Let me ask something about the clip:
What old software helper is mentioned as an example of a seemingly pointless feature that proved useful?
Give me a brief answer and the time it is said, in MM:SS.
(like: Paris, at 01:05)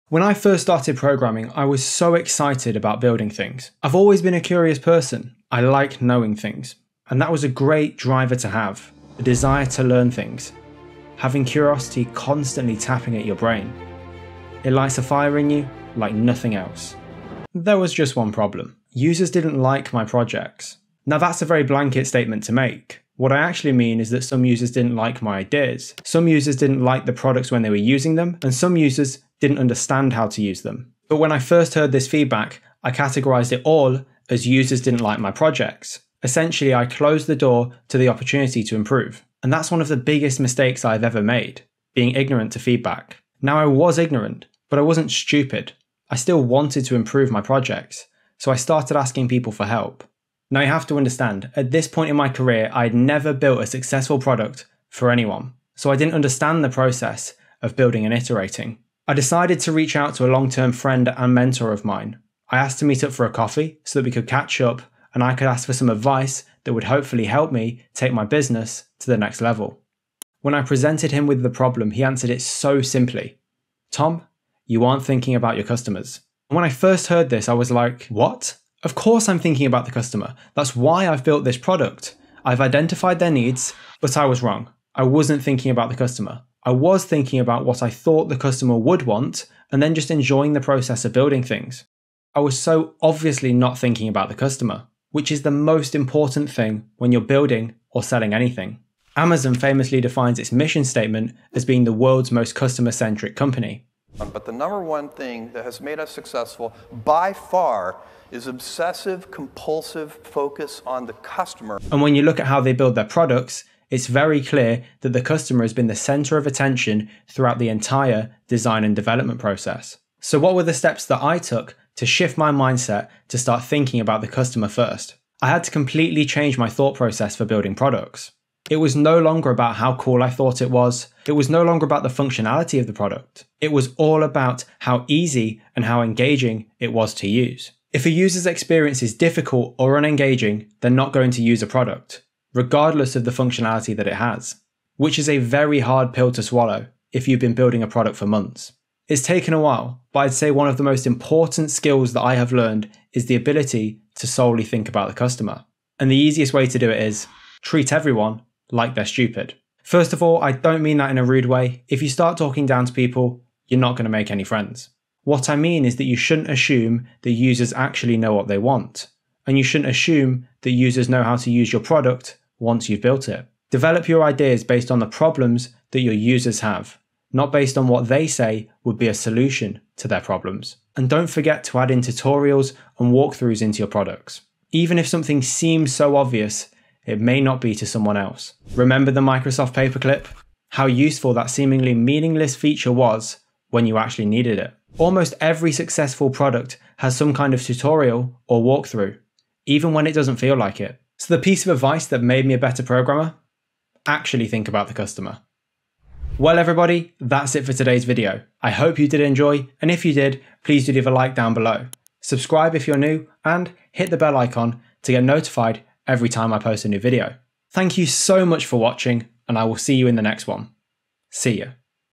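The Microsoft paperclip, at 03:09.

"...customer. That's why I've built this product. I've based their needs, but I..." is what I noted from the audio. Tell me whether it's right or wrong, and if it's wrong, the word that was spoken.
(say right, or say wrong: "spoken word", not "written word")
wrong: "identified", not "based".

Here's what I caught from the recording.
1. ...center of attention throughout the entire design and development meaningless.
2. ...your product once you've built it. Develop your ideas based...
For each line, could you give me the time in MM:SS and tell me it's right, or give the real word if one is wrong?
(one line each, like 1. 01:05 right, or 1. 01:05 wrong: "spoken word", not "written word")
1. 01:55 wrong: "process", not "meaningless"
2. 02:51 right.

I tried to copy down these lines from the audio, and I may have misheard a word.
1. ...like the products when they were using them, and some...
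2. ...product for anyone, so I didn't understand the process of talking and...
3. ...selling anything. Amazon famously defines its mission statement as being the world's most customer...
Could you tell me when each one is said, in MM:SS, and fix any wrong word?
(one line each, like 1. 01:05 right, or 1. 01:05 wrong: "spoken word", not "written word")
1. 00:26 right
2. 00:54 wrong: "building", not "talking"
3. 01:38 right.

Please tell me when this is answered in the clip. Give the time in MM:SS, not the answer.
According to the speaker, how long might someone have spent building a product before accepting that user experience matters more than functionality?
02:28.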